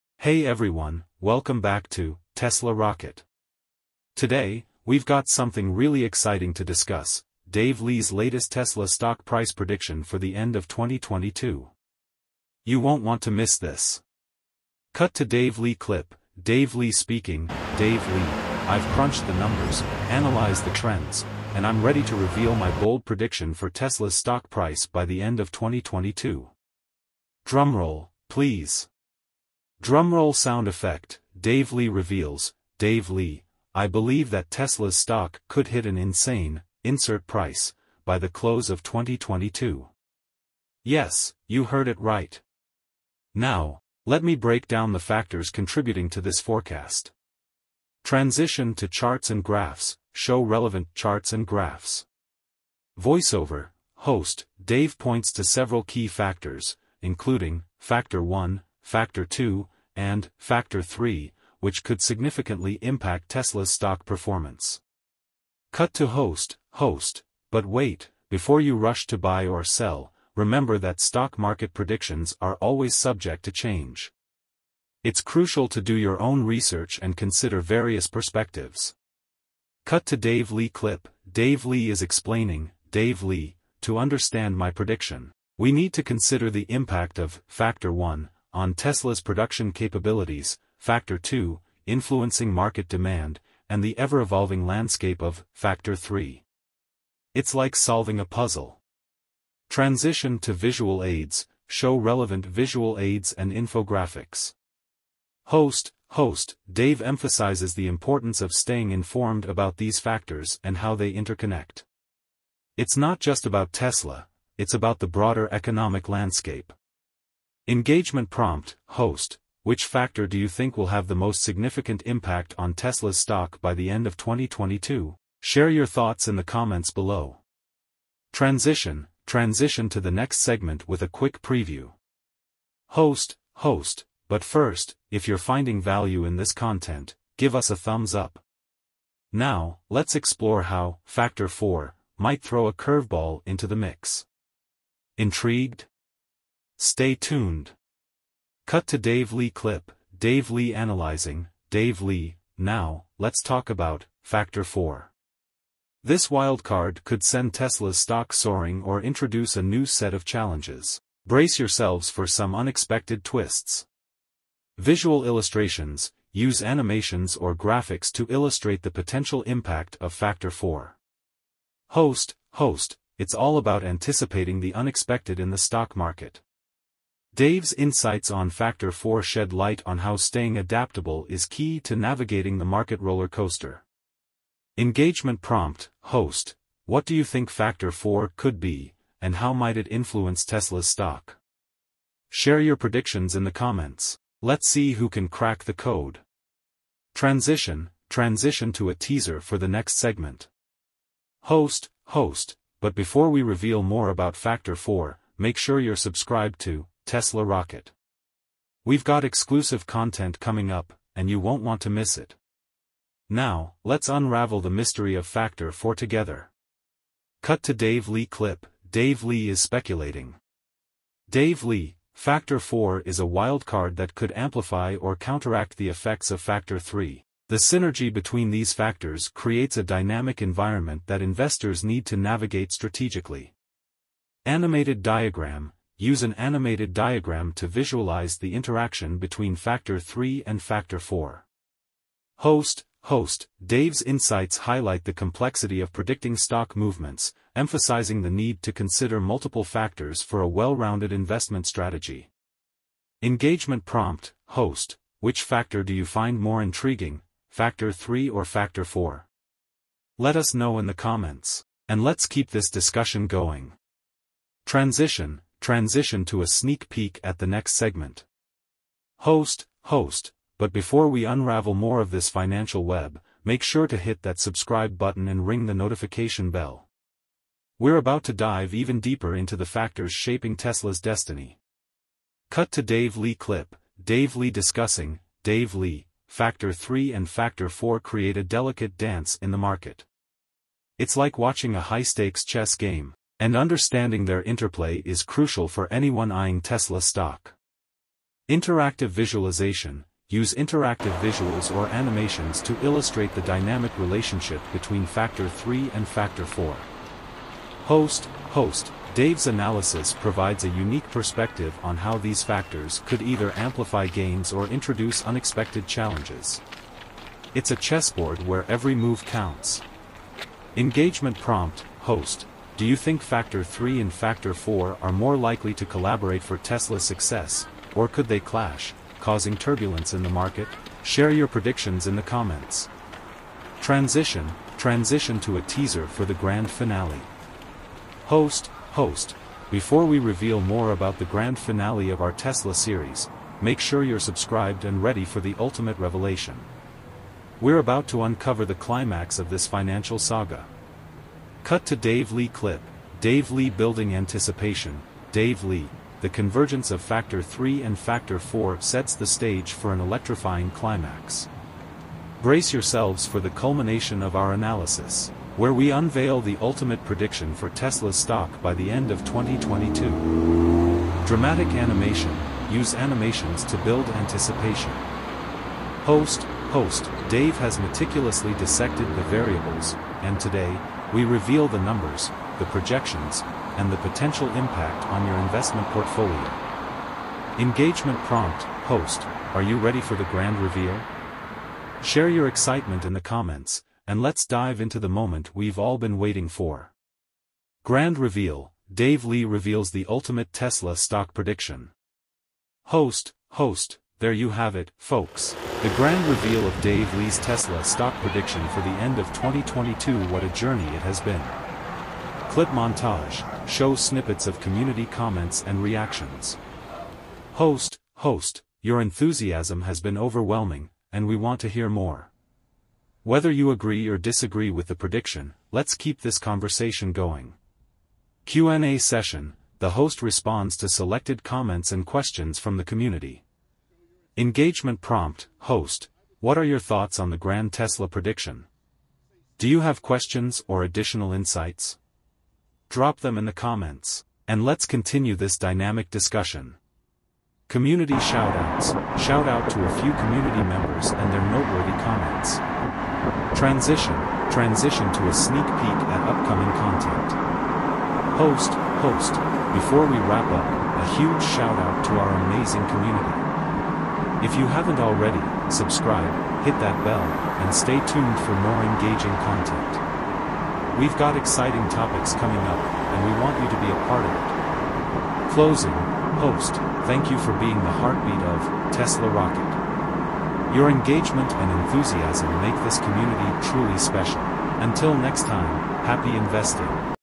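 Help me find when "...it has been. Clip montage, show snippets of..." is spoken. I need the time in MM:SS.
06:50.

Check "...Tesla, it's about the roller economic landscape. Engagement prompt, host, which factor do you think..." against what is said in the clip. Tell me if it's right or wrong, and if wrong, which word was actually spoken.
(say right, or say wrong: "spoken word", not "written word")
wrong: "broader", not "roller".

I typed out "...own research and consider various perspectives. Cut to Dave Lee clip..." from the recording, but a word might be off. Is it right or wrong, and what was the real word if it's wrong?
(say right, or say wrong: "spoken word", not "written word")
right.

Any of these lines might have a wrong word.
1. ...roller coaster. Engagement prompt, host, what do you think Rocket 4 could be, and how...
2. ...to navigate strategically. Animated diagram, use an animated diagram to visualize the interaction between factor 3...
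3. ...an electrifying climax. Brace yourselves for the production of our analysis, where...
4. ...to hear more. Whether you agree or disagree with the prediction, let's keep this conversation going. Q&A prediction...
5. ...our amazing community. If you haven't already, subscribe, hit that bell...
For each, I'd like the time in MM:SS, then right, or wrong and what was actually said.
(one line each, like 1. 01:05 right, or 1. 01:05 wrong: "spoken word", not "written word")
1. 03:02 wrong: "Factor", not "Rocket"
2. 03:52 right
3. 05:59 wrong: "culmination", not "production"
4. 07:01 wrong: "session", not "prediction"
5. 07:42 right.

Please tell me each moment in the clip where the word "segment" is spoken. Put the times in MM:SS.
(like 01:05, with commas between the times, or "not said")
02:10, 03:19, 04:27.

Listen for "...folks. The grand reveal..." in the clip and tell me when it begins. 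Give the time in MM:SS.
06:44.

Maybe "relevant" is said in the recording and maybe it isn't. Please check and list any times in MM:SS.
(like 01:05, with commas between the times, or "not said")
00:50, 01:41.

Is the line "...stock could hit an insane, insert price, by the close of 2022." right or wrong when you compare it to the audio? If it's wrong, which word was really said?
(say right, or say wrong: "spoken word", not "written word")
right.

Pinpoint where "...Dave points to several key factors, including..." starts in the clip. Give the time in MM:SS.
00:54.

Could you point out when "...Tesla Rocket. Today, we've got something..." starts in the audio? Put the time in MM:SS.
00:02.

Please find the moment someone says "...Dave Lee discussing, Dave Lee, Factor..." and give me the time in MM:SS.
04:44.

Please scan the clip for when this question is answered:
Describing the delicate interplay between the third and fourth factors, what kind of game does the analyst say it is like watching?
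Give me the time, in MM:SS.
04:51.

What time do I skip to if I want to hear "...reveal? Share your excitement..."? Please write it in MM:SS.
06:30.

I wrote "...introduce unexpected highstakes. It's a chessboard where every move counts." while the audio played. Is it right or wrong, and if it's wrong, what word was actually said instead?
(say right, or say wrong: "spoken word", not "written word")
wrong: "challenges", not "highstakes".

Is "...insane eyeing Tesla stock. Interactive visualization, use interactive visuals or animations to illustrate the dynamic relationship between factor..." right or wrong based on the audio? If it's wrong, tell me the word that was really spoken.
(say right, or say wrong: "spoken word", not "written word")
wrong: "anyone", not "insane".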